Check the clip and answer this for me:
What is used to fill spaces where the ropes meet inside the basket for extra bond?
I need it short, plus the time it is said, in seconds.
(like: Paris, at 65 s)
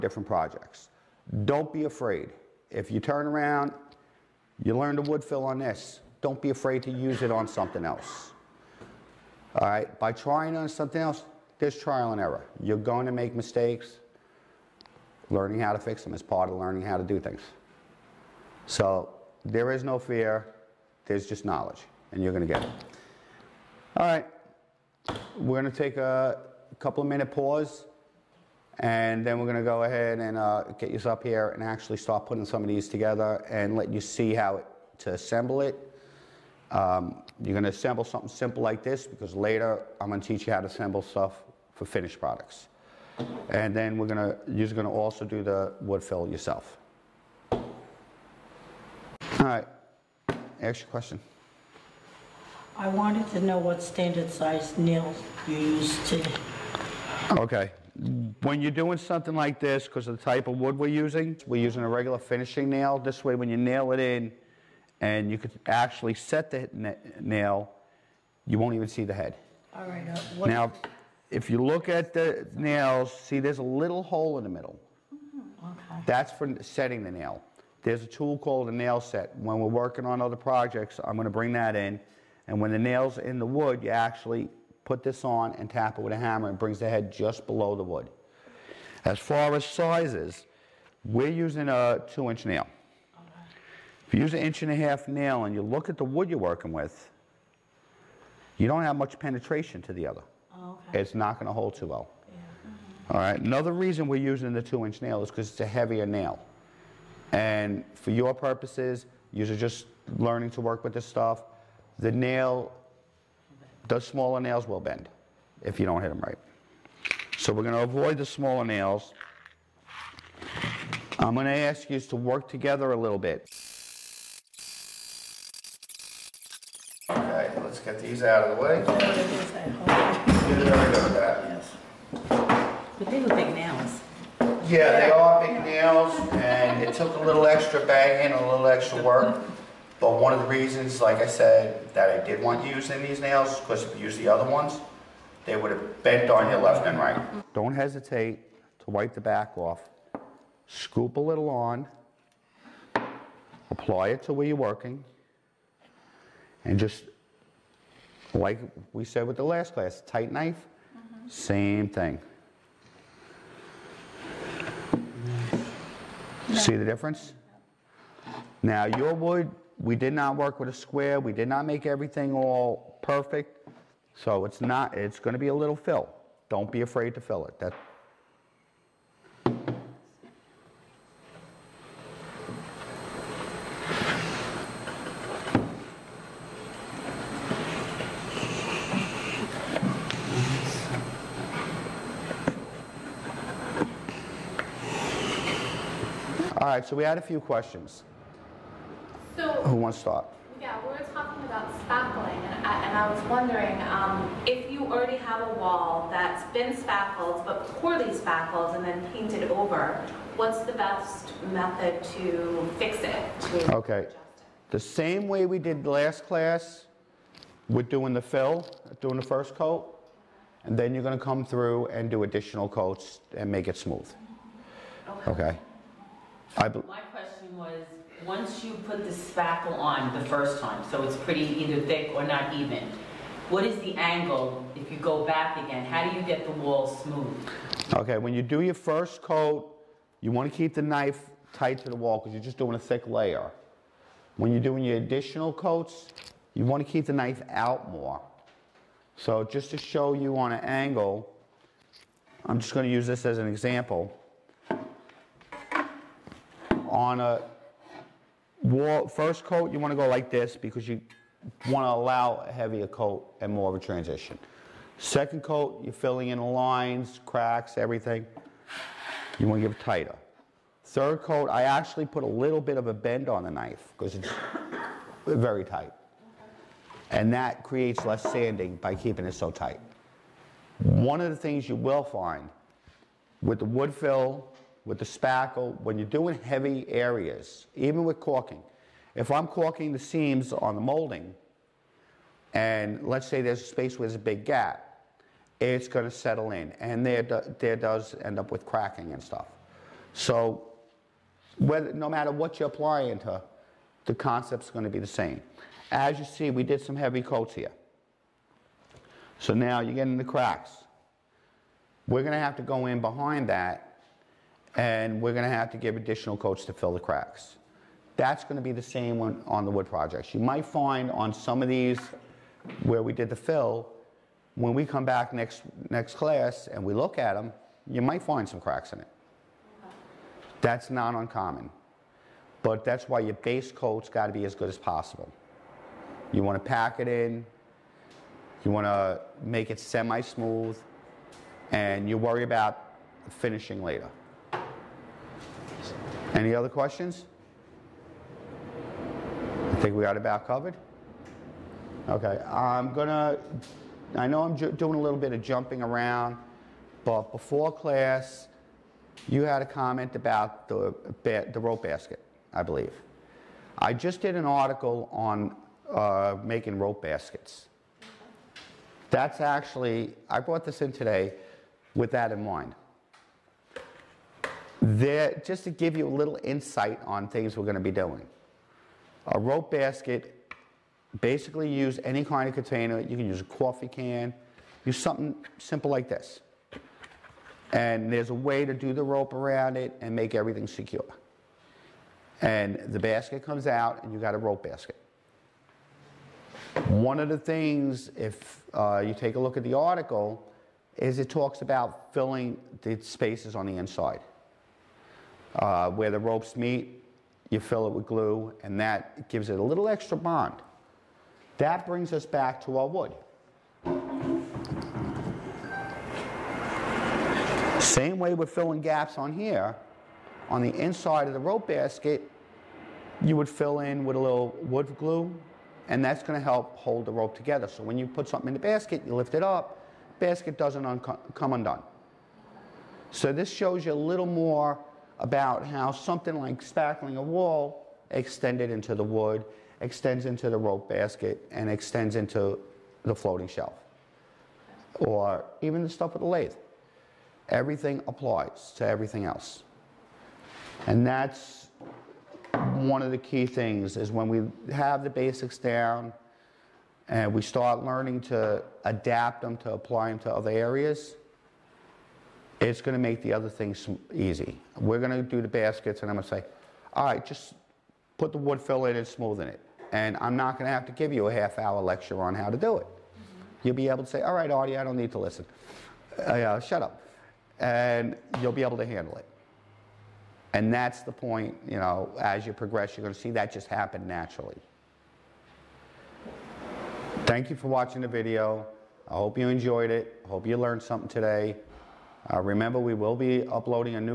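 wood glue, at 424 s.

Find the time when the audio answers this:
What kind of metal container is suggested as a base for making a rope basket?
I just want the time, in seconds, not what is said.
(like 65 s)
383 s.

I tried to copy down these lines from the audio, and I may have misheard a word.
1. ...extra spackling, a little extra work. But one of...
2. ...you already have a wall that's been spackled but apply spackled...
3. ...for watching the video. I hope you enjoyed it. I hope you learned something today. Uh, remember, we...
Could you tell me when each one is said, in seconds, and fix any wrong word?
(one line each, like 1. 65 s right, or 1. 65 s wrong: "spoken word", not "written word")
1. 137 s wrong: "banging", not "spackling"
2. 204 s wrong: "poorly", not "apply"
3. 487 s right.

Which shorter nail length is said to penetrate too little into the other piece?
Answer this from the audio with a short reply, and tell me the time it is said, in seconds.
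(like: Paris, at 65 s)
inch and a half, at 94 s.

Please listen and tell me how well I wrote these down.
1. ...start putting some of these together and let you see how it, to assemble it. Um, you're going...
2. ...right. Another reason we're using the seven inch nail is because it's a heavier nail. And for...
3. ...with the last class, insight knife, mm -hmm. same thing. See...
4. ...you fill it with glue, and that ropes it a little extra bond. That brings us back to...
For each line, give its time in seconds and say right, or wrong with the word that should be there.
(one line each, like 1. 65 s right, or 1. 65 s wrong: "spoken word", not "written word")
1. 31 s right
2. 103 s wrong: "two", not "seven"
3. 159 s wrong: "tight", not "insight"
4. 407 s wrong: "gives", not "ropes".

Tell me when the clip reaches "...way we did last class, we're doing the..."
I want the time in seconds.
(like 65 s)
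215 s.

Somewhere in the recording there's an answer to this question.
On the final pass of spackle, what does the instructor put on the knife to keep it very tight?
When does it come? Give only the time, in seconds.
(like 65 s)
272 s.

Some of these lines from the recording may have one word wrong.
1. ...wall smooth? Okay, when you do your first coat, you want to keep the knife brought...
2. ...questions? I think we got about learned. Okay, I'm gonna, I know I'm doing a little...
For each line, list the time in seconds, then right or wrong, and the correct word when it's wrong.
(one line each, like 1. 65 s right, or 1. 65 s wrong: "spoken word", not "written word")
1. 236 s wrong: "tight", not "brought"
2. 346 s wrong: "covered", not "learned".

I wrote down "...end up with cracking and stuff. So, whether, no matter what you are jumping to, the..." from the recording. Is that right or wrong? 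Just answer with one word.
wrong.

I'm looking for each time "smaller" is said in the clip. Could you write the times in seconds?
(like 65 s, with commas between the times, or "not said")
113 s, 118 s.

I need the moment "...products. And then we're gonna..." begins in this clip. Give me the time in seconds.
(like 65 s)
42 s.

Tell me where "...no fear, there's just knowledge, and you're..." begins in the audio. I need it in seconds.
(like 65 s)
19 s.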